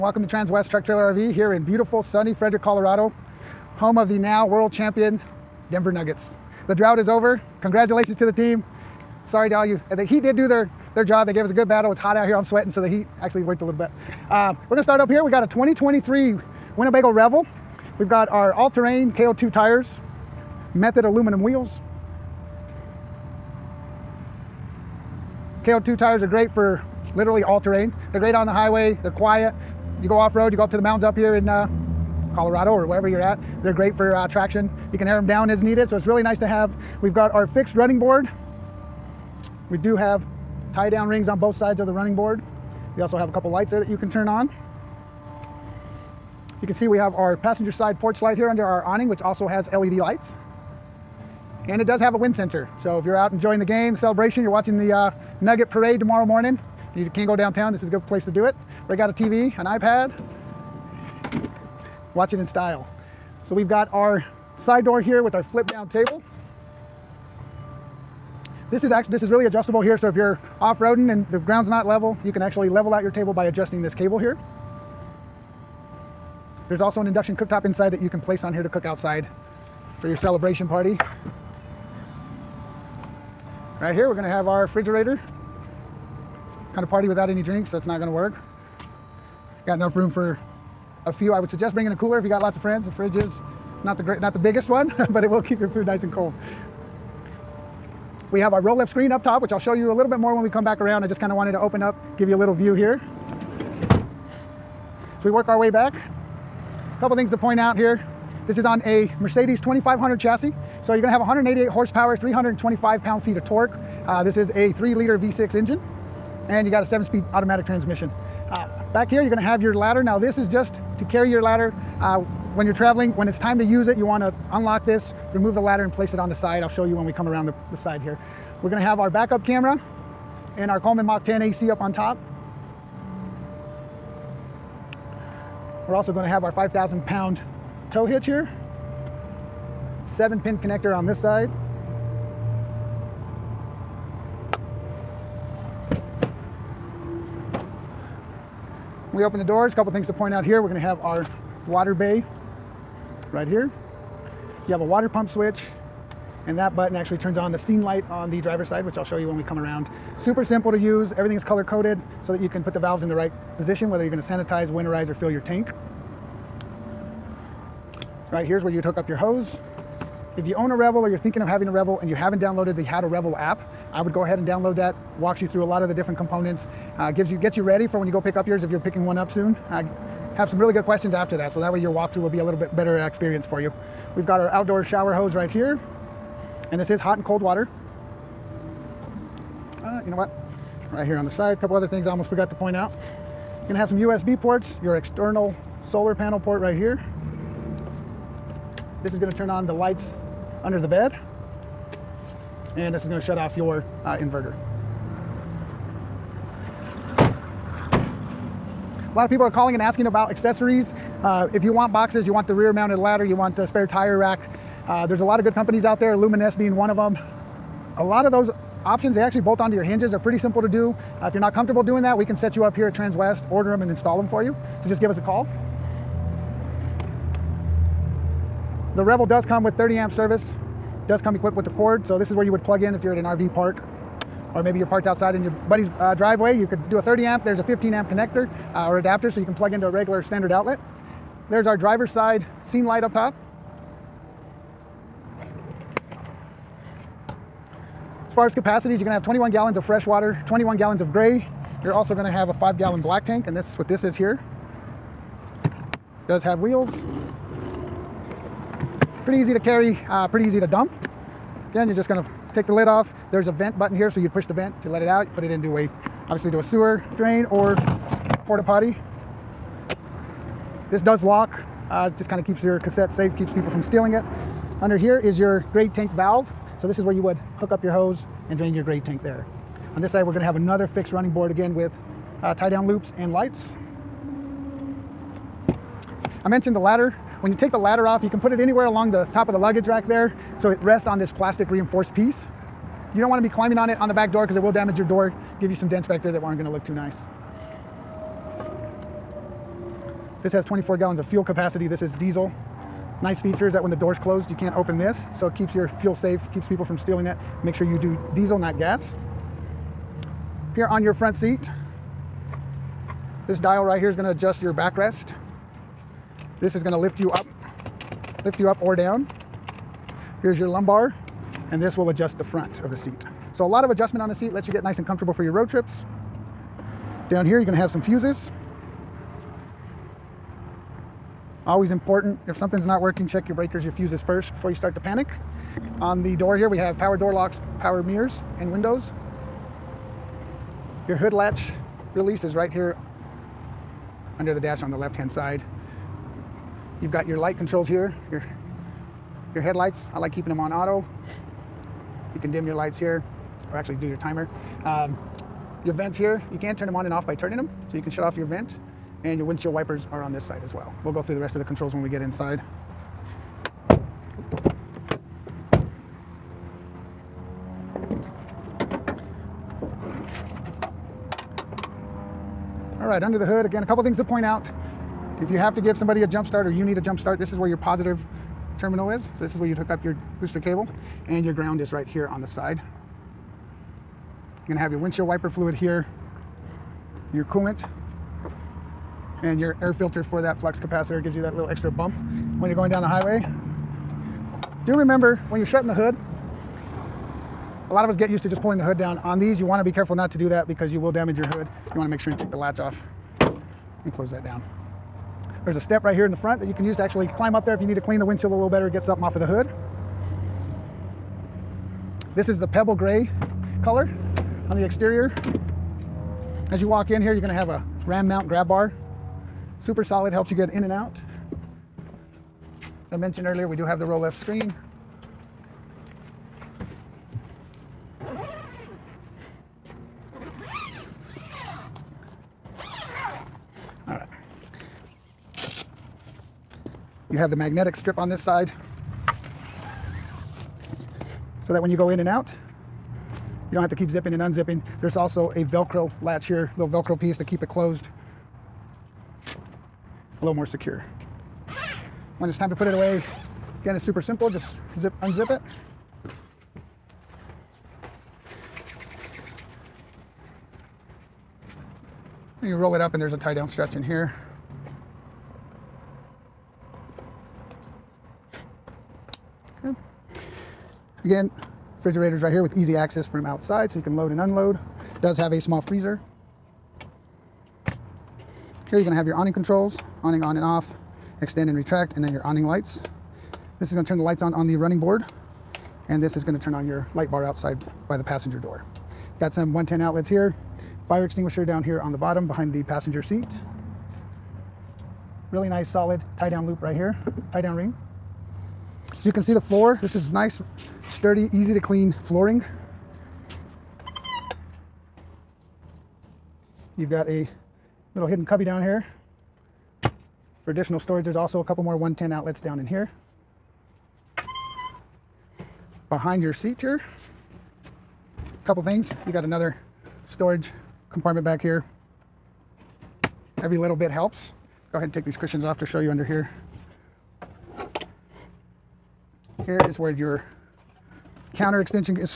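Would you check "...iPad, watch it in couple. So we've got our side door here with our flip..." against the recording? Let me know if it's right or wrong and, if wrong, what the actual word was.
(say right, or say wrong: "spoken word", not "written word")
wrong: "style", not "couple".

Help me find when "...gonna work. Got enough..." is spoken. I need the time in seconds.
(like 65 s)
88 s.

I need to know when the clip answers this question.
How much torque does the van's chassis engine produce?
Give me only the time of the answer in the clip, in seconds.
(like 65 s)
112 s.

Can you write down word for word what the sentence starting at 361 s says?
We'll go through the rest of the controls when we get inside.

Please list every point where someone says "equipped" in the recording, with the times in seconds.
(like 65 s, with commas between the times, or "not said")
231 s.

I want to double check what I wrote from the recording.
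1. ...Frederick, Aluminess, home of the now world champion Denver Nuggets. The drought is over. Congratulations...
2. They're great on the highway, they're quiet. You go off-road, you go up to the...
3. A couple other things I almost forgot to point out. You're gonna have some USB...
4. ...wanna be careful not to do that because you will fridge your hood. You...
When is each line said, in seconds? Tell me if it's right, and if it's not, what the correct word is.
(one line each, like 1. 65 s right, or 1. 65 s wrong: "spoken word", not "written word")
1. 2 s wrong: "Colorado", not "Aluminess"
2. 28 s right
3. 191 s right
4. 399 s wrong: "damage", not "fridge".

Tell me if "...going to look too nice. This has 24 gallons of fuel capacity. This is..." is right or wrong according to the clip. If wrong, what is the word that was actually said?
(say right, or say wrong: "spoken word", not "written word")
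right.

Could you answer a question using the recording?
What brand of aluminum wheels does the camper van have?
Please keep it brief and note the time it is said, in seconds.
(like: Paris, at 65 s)
Method, at 20 s.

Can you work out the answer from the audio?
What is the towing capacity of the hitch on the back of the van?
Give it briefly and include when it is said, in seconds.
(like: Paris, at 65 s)
5,000 pounds, at 136 s.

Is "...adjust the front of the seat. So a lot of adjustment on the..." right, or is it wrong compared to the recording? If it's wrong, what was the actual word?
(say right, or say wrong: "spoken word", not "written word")
right.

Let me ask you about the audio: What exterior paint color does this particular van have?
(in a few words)
pebble gray.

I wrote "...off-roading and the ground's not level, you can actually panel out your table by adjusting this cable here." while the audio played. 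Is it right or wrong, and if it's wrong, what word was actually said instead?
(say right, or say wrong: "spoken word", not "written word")
wrong: "level", not "panel".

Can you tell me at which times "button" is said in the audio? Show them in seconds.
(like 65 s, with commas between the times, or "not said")
156 s, 263 s.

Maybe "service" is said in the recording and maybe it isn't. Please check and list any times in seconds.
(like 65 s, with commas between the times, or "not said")
230 s.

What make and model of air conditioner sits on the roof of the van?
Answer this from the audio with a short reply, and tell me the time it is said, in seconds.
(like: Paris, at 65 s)
Coleman Mach 10, at 130 s.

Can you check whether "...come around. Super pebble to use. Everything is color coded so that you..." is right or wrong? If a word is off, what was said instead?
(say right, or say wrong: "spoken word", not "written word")
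wrong: "simple", not "pebble".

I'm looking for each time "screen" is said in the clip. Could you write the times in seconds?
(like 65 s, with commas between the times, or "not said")
98 s, 424 s.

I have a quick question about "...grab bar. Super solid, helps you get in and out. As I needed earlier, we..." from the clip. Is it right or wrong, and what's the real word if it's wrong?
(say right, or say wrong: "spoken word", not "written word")
wrong: "mentioned", not "needed".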